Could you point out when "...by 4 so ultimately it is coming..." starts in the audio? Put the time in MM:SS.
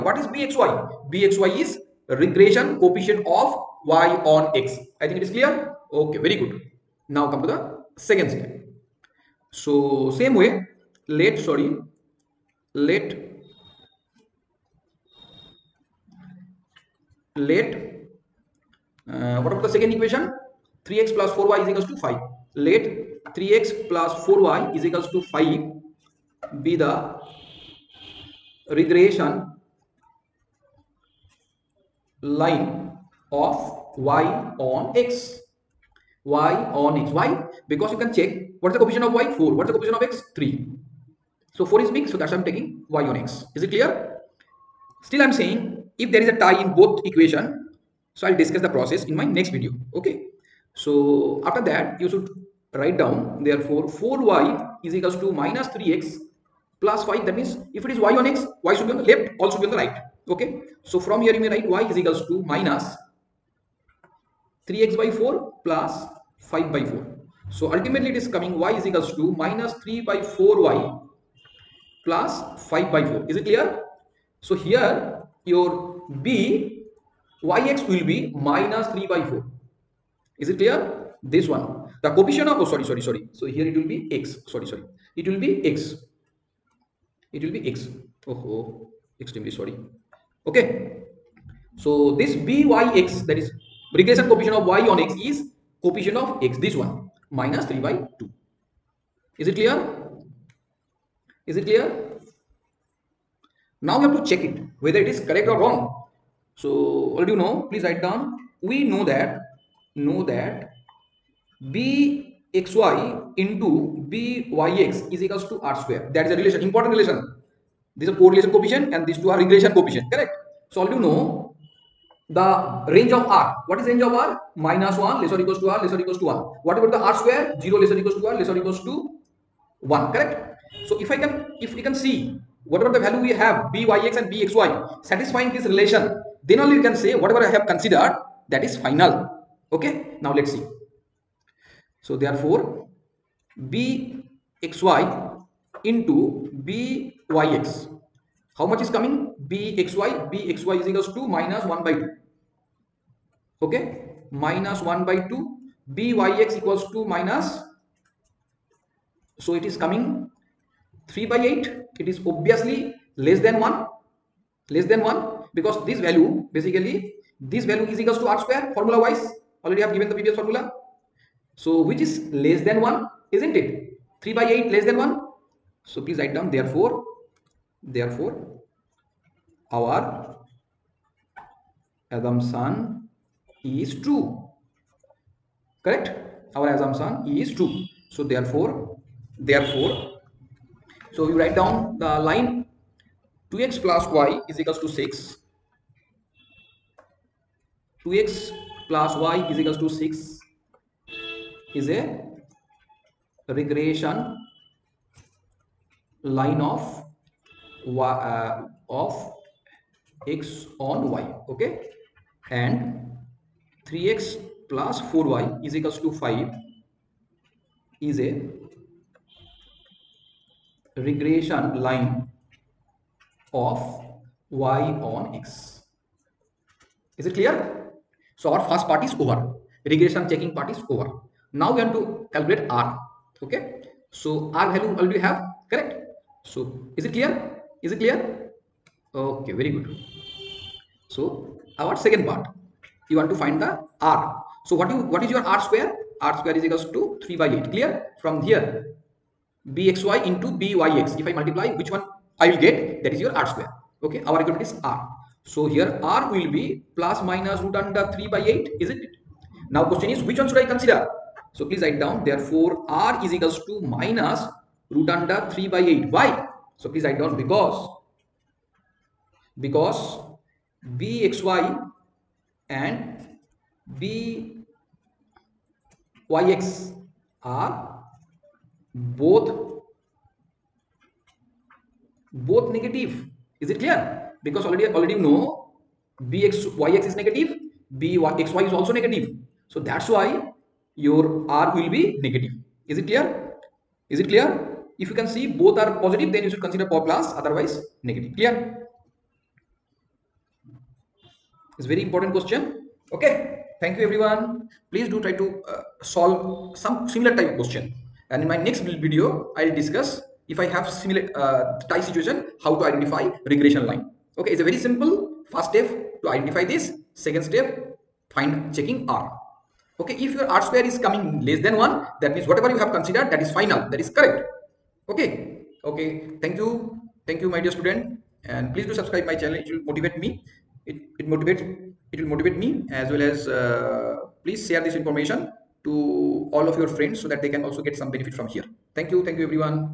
01:06.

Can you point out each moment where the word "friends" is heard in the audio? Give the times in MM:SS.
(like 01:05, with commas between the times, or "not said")
05:36.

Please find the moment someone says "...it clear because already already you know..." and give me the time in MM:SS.
04:43.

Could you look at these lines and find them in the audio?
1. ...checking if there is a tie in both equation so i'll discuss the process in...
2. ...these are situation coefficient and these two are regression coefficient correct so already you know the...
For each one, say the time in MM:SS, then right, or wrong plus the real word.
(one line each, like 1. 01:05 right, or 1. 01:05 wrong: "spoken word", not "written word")
1. 00:45 wrong: "saying", not "checking"
2. 01:57 wrong: "correlation", not "situation".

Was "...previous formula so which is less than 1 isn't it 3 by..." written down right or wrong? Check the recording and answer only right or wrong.
right.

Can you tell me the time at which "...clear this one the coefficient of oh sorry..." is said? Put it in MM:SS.
01:20.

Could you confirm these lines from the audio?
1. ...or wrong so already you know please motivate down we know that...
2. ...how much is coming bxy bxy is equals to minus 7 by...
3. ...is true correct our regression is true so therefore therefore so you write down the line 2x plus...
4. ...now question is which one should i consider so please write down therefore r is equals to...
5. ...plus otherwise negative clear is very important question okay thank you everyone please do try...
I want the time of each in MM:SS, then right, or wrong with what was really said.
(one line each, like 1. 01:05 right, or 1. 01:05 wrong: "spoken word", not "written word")
1. 01:45 wrong: "write", not "motivate"
2. 02:28 wrong: "1", not "7"
3. 03:03 wrong: "assumption", not "regression"
4. 04:19 right
5. 04:56 right.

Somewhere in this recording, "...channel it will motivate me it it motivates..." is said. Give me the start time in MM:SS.
05:29.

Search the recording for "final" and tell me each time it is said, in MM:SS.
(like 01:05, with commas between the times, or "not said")
02:18, 05:23.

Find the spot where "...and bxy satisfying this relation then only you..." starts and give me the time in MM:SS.
02:14.